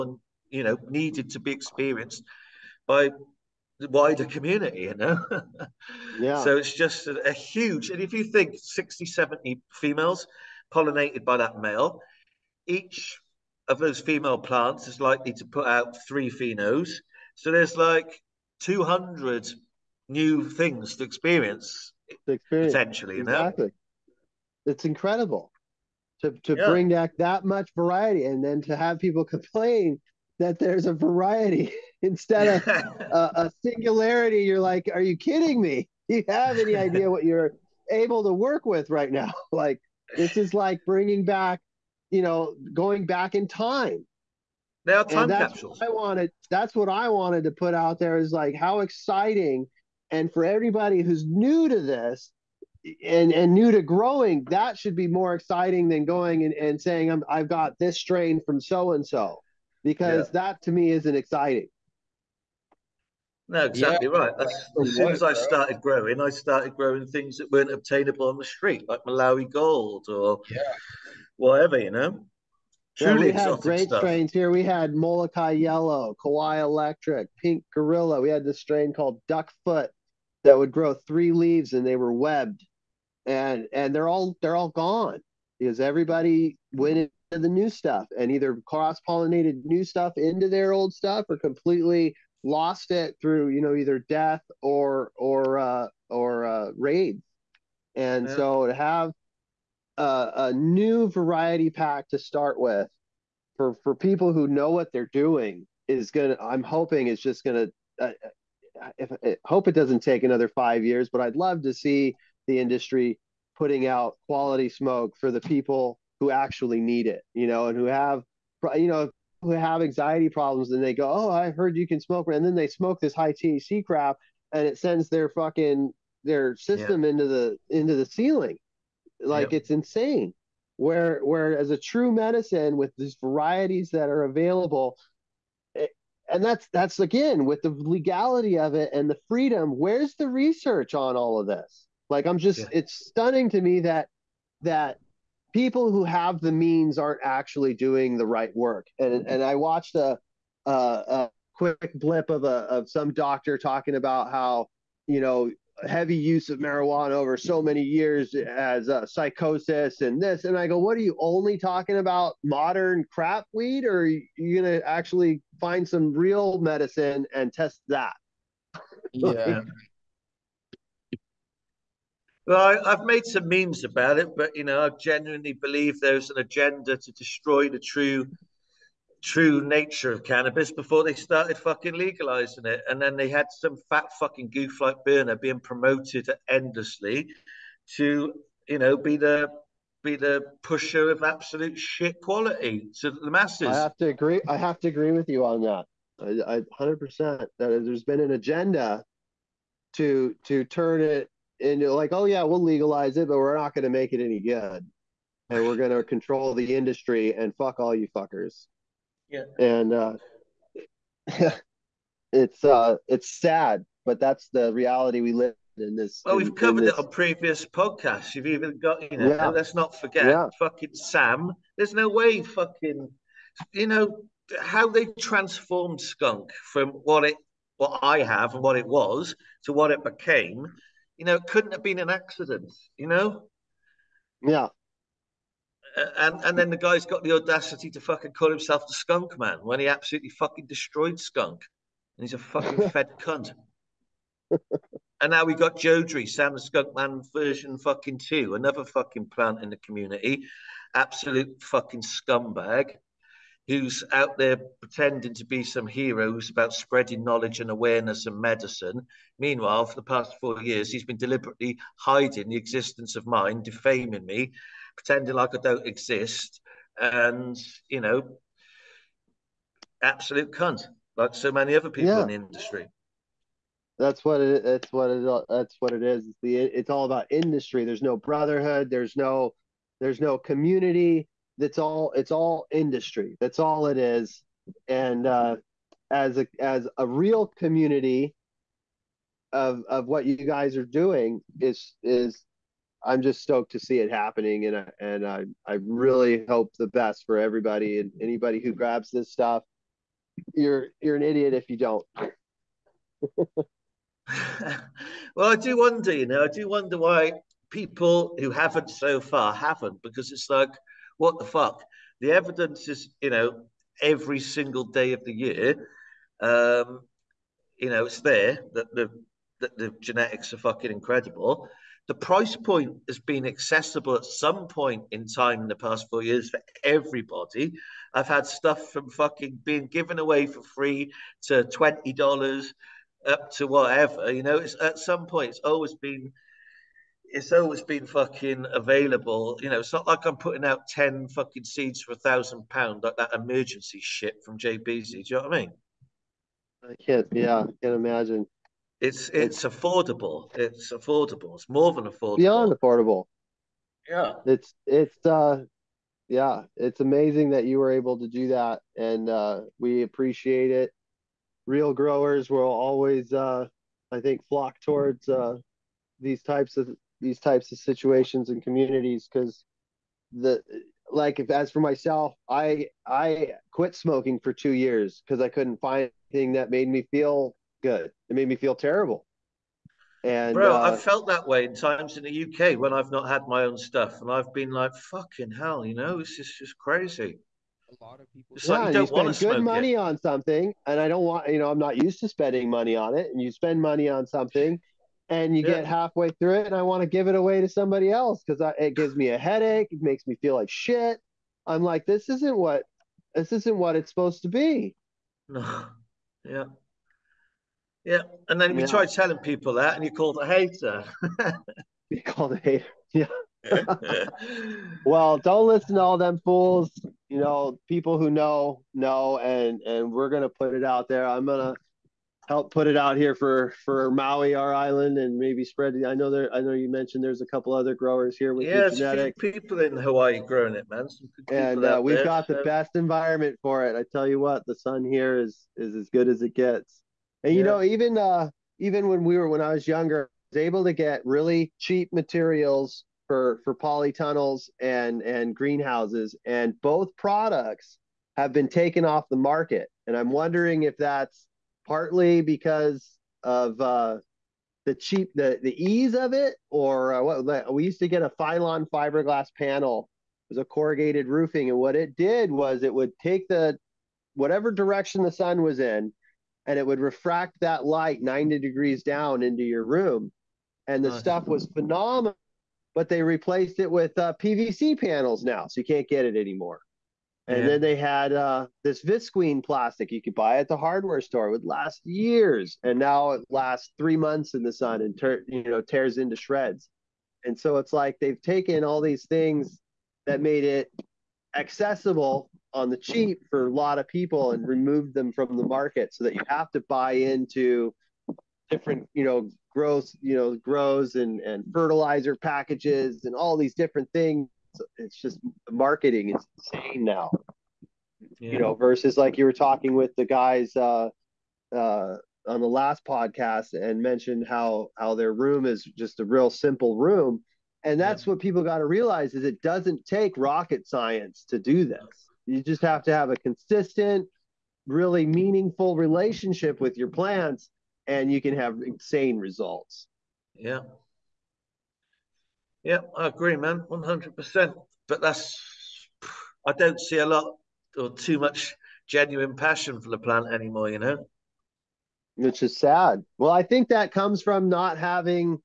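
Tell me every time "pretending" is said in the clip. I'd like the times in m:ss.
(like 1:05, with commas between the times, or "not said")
4:14, 4:24.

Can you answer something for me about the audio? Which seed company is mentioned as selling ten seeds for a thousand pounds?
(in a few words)
JBZ.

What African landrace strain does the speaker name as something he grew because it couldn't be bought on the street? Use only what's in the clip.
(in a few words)
Malawi Gold.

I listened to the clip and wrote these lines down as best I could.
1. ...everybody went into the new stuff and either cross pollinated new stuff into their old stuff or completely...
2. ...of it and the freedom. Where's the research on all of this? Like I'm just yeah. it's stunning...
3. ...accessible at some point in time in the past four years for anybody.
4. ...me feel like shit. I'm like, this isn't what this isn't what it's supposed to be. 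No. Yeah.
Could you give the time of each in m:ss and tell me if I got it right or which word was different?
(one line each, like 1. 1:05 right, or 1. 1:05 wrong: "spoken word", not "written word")
1. 1:25 right
2. 2:18 right
3. 5:23 wrong: "everybody", not "anybody"
4. 6:40 right.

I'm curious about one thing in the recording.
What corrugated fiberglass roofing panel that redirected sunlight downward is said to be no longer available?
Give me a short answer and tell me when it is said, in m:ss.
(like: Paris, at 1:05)
Phylon, at 7:38.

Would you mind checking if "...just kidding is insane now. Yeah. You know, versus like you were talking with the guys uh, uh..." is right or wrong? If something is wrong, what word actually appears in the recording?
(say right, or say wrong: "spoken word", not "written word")
wrong: "marketing", not "kidding".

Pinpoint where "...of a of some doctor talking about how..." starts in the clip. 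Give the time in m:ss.
2:32.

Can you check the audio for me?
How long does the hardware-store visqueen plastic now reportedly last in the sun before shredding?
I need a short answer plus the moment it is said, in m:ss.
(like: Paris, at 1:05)
3 months, at 8:03.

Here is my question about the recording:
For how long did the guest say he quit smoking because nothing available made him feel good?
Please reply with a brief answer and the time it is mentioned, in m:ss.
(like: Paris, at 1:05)
2 years, at 6:14.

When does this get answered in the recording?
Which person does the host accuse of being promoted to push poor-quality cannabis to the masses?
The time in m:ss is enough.
3:05.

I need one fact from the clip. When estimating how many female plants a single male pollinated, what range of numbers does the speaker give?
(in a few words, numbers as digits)
60-70.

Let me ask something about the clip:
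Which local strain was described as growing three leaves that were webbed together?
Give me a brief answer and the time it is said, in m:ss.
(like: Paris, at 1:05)
Duckfoot, at 1:19.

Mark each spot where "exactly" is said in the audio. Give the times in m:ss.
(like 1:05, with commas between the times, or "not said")
0:23, 1:03.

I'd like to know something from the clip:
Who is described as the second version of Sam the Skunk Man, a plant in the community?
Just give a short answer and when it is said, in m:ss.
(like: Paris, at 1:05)
Jodrey, at 4:05.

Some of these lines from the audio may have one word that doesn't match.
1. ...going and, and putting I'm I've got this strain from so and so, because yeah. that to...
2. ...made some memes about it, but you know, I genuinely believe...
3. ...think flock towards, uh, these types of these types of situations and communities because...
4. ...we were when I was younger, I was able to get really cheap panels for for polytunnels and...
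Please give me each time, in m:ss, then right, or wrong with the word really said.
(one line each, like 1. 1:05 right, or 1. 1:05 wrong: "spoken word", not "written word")
1. 0:56 wrong: "saying", not "putting"
2. 2:53 right
3. 6:04 right
4. 7:19 wrong: "materials", not "panels".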